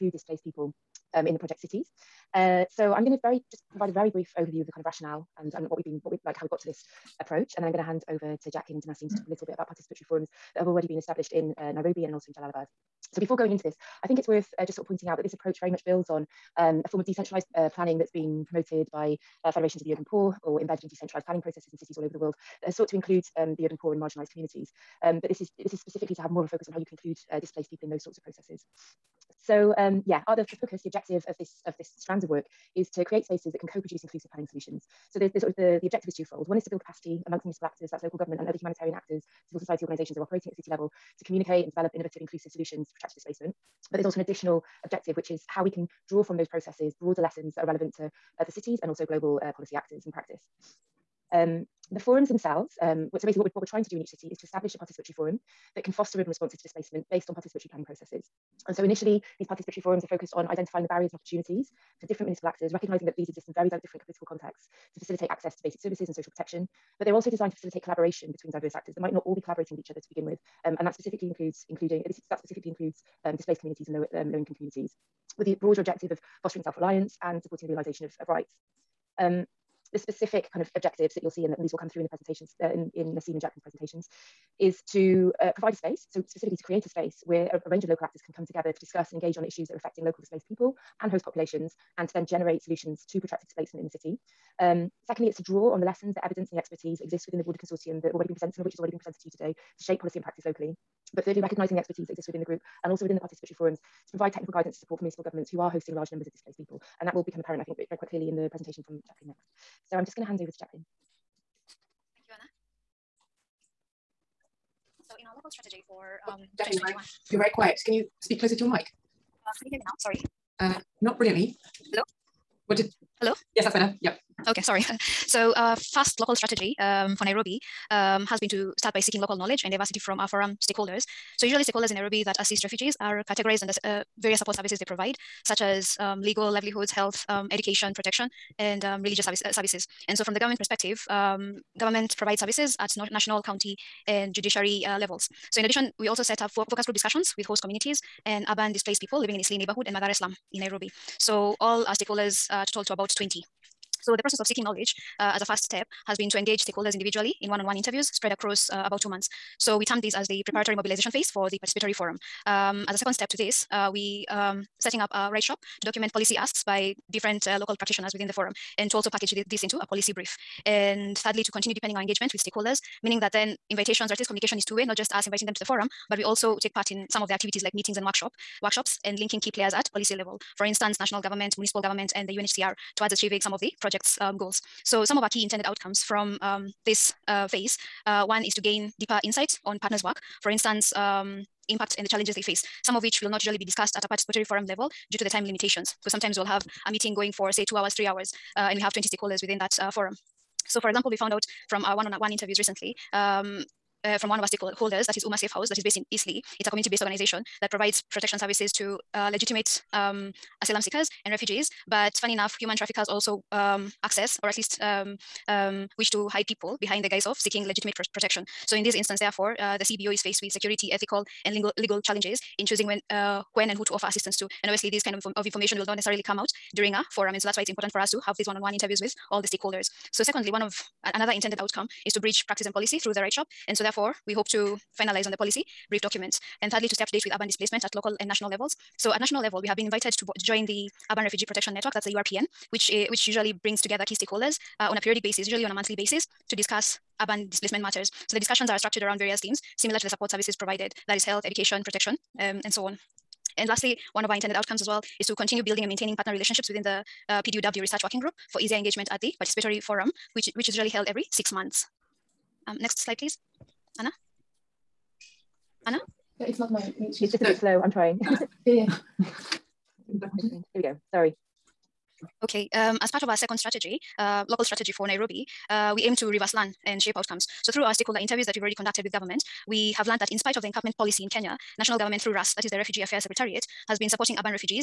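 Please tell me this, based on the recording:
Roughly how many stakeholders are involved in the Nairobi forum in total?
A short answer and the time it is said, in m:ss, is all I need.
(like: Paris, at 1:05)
20, at 2:32.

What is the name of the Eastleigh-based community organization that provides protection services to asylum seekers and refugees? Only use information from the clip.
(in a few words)
UMA Safe House.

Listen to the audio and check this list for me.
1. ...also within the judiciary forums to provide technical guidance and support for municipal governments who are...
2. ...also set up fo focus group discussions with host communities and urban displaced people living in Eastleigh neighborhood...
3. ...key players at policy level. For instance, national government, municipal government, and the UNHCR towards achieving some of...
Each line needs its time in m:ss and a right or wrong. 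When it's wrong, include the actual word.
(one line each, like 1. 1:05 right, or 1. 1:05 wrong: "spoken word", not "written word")
1. 1:42 wrong: "participatory", not "judiciary"
2. 2:26 right
3. 2:59 right.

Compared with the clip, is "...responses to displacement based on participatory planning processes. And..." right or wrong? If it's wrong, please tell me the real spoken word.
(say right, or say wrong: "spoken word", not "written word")
right.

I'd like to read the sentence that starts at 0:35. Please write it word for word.
So the, the sort of the, the objective is twofold.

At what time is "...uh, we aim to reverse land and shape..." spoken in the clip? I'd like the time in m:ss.
4:35.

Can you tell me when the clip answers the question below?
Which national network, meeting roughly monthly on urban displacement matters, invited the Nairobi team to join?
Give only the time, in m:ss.
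4:01.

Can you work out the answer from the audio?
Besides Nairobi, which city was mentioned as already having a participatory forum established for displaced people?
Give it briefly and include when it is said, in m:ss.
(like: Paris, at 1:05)
Jalalabad, at 0:12.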